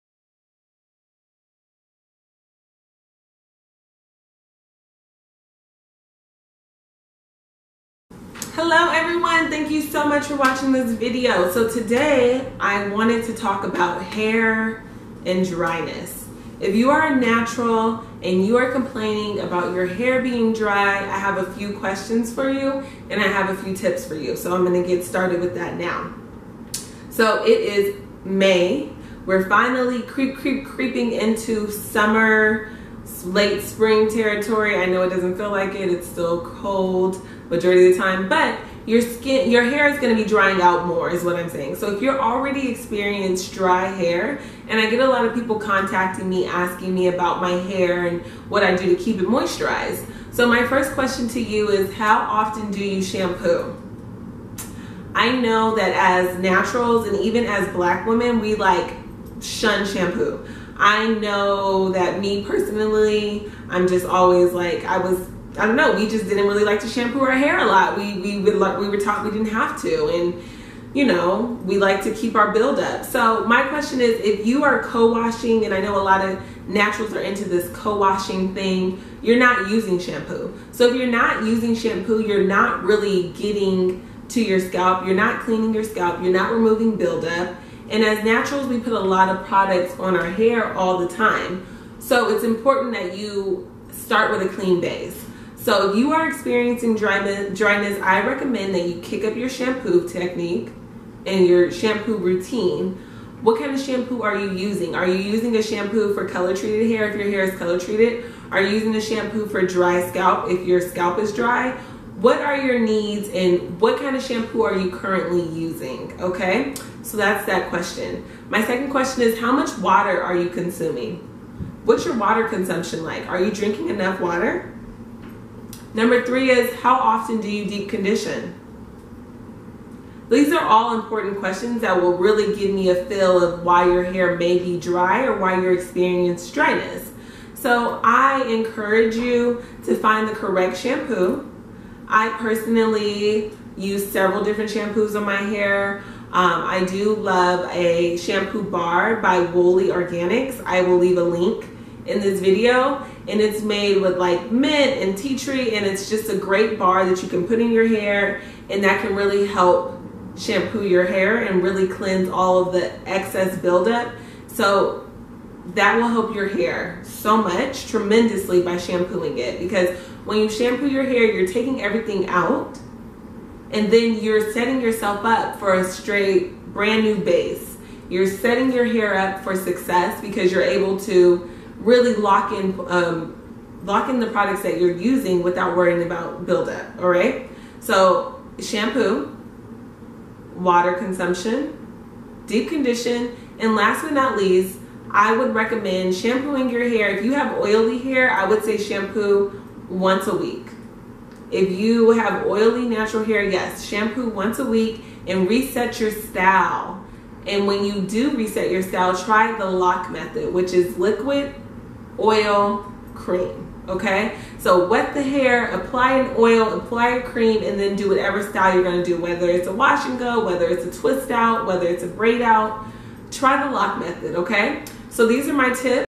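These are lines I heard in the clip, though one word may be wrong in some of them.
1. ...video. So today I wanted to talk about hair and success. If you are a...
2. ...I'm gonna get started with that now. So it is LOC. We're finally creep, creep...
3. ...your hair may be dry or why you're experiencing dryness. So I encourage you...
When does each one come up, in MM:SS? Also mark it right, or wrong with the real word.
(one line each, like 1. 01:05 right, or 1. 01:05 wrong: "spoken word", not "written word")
1. 00:10 wrong: "dryness", not "success"
2. 00:24 wrong: "May", not "LOC"
3. 02:13 right.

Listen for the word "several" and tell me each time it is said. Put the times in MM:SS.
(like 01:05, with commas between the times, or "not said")
02:24.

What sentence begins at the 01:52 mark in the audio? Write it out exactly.
What are your needs and what kind of shampoo are you currently using?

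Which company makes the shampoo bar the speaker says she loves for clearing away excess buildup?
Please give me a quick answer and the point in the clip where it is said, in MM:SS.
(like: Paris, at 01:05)
Woolly Organics, at 02:29.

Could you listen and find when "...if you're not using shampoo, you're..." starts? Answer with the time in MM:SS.
01:20.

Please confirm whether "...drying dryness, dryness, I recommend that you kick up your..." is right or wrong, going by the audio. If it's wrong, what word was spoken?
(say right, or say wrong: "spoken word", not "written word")
wrong: "experiencing", not "drying".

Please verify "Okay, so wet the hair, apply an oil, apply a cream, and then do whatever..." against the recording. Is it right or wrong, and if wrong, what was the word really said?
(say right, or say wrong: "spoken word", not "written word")
right.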